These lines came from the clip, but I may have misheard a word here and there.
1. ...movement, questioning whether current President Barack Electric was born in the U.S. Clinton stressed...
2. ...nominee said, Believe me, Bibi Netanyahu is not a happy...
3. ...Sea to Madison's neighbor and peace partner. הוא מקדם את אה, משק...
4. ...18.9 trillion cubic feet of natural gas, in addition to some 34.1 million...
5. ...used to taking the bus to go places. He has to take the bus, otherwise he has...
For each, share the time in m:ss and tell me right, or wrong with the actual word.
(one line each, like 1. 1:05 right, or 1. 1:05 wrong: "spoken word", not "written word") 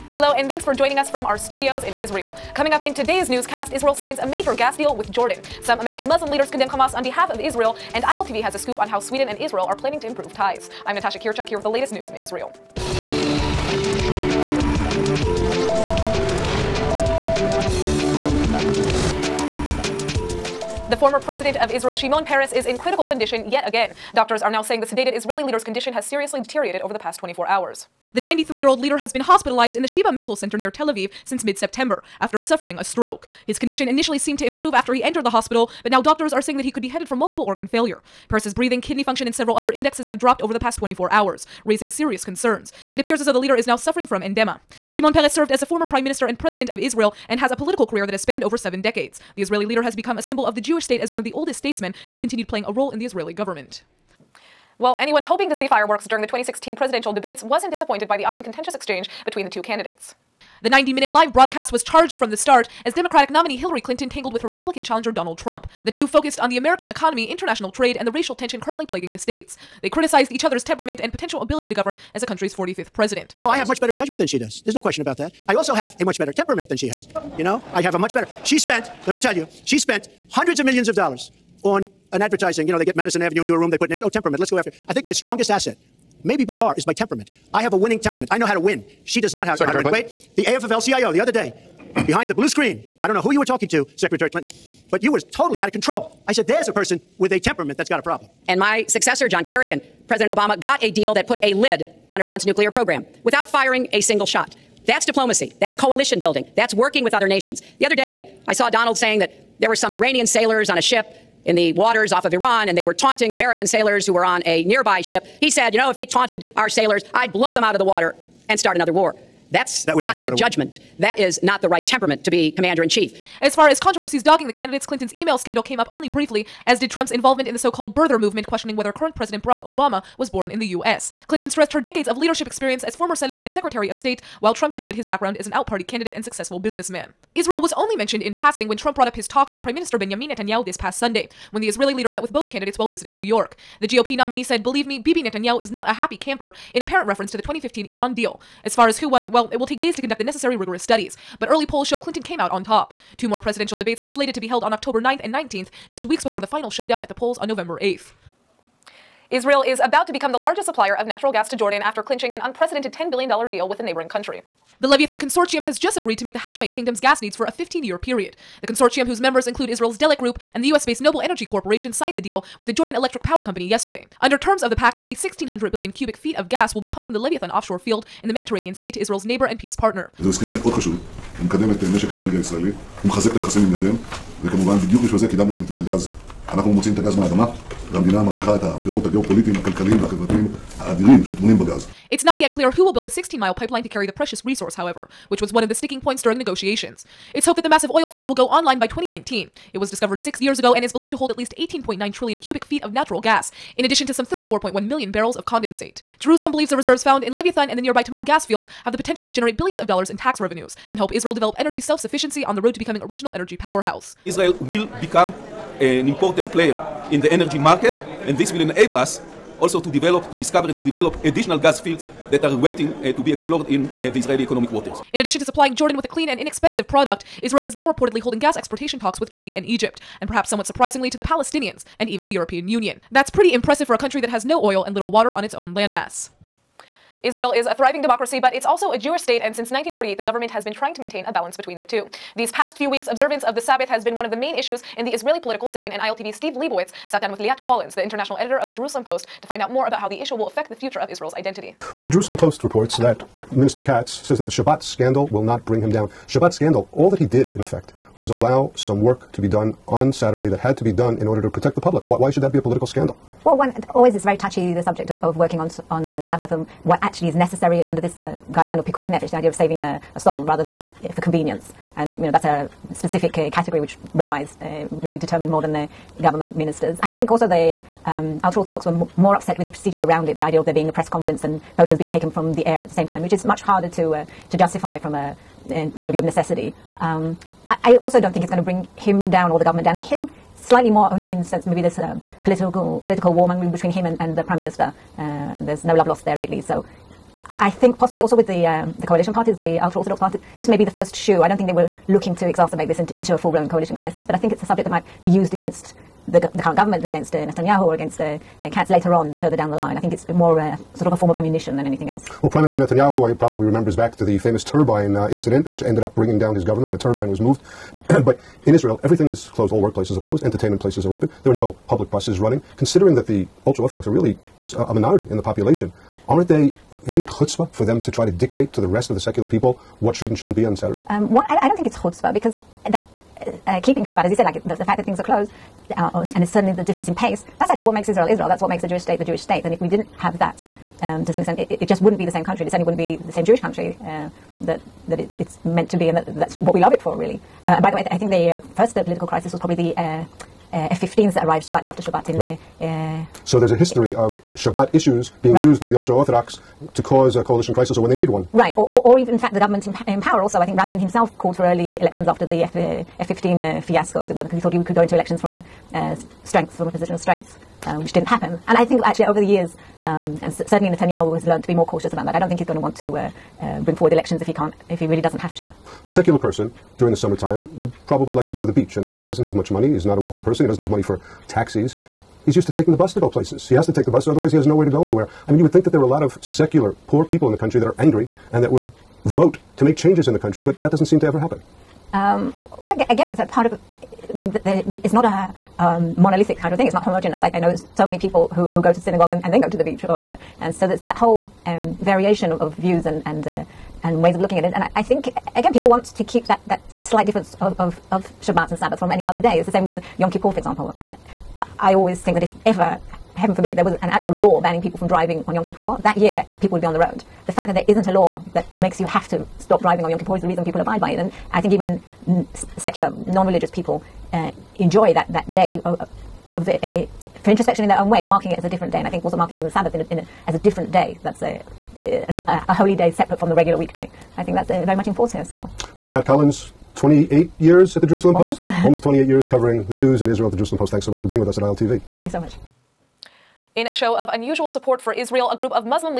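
1. 2:08 wrong: "Obama", not "Electric"
2. 2:24 right
3. 2:58 wrong: "Israel", not "Madison"
4. 3:21 right
5. 6:22 right.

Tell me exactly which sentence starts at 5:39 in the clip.
And if we didn't have that, um, to some extent, it, it, it, just wouldn't be the same country.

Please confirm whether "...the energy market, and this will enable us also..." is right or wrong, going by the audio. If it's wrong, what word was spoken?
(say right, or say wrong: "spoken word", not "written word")
right.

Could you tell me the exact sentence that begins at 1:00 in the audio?
The 90 minute live broadcast was charged from the start as Democratic nominee Hillary Clinton tangled with her Republican challenger Donald Trump.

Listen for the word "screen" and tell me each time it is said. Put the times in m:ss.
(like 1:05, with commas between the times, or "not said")
1:32.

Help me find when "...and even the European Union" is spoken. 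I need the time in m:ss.
3:51.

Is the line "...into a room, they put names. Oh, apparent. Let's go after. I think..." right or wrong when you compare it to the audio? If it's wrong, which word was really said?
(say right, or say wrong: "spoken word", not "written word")
wrong: "temperament", not "apparent".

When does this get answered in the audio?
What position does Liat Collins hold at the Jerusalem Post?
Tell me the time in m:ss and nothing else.
4:08.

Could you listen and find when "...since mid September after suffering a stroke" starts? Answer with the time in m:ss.
0:31.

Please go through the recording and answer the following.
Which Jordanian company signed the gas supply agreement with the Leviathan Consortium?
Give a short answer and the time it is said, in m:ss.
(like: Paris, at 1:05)
Jordan Electric Power Company, at 2:52.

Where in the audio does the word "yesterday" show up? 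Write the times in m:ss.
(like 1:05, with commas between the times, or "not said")
2:53.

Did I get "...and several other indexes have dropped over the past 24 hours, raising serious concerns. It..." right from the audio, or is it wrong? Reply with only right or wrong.
right.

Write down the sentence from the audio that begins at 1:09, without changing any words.
They criticized each other's temperament and potential ability to govern as the country's 45th president.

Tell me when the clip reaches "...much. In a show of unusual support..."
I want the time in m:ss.
7:22.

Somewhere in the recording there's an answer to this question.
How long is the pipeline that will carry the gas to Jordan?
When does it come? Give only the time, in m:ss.
3:13.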